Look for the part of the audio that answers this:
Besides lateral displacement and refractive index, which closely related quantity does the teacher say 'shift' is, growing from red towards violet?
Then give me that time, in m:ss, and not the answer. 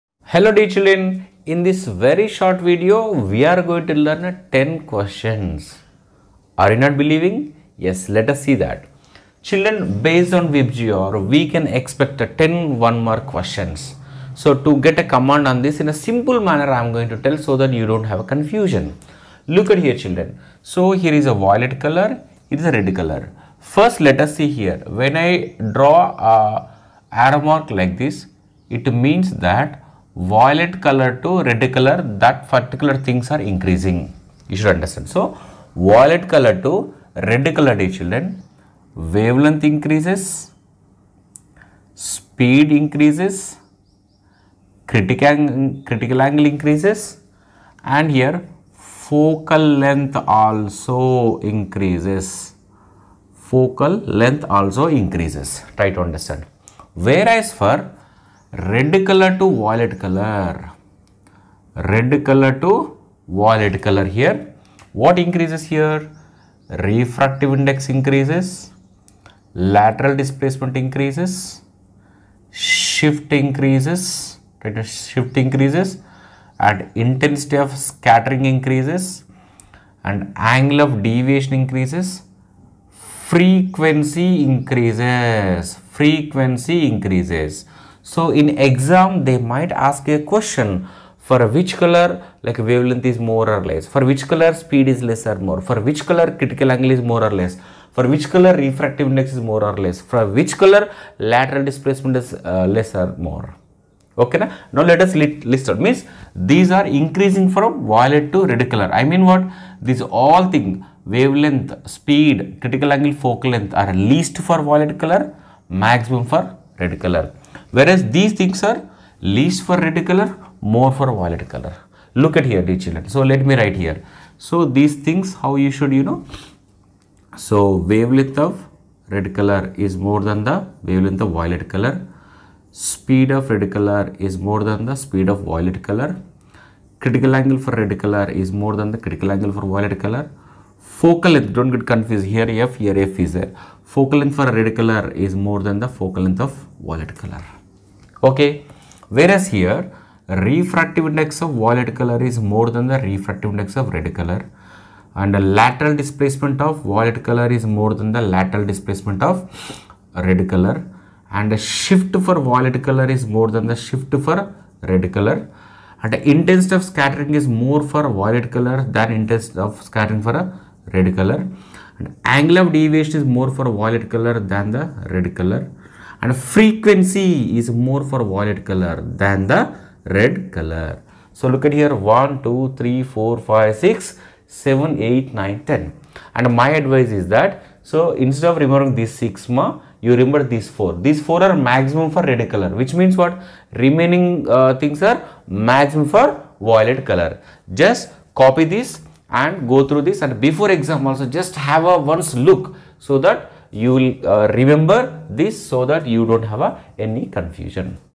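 1:14.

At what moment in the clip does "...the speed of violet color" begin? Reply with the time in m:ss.
2:14.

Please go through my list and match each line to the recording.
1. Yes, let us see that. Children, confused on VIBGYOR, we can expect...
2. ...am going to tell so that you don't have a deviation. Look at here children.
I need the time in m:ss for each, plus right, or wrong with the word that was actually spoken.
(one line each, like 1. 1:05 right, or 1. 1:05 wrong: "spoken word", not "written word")
1. 0:07 wrong: "based", not "confused"
2. 0:16 wrong: "confusion", not "deviation".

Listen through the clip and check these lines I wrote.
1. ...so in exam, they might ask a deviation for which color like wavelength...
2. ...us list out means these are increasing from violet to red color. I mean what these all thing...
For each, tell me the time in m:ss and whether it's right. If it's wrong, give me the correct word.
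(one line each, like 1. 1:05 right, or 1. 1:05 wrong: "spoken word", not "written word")
1. 1:28 wrong: "question", not "deviation"
2. 1:45 right.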